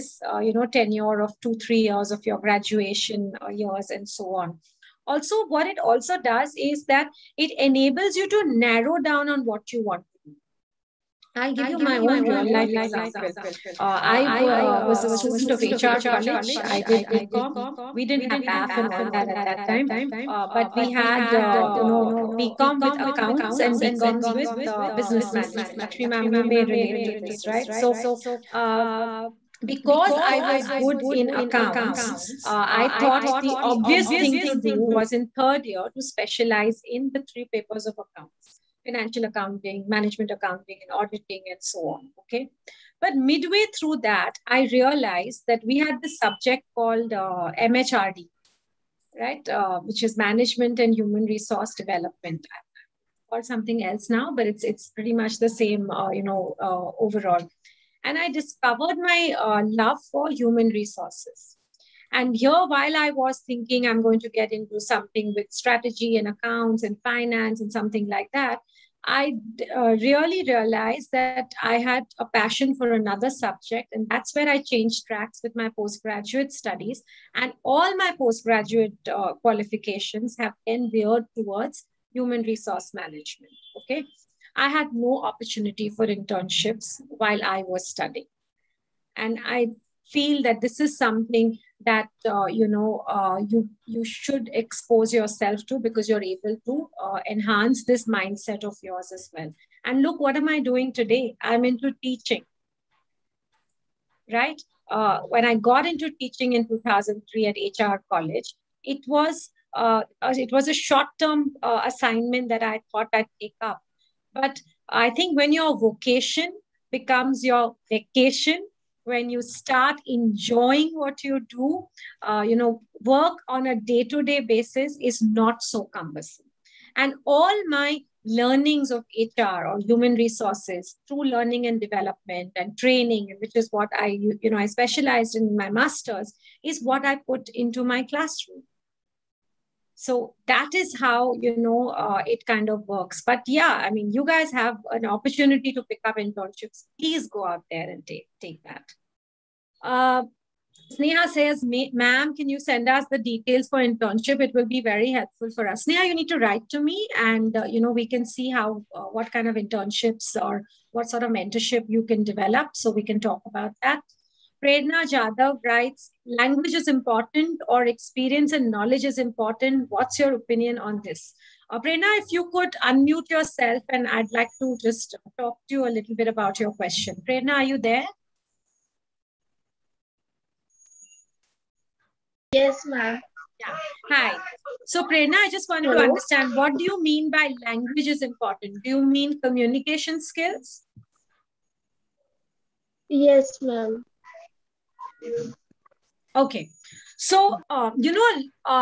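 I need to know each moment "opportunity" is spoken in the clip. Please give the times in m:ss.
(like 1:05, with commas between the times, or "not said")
1:25, 2:25.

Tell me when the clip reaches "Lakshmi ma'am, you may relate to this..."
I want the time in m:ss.
0:25.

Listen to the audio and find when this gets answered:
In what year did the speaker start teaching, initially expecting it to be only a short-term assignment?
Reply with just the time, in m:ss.
1:46.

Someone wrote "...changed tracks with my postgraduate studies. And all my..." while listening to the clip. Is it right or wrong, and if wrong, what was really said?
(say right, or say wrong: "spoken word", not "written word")
right.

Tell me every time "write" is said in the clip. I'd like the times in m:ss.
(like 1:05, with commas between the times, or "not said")
2:36, 2:45.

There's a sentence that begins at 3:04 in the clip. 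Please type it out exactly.
So Prerna, I just wanted Hello.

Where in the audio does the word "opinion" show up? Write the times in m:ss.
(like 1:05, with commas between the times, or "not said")
2:50.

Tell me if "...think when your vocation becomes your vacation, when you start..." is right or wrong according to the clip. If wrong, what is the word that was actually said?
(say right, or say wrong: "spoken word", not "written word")
right.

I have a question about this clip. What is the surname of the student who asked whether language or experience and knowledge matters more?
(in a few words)
Jadhav.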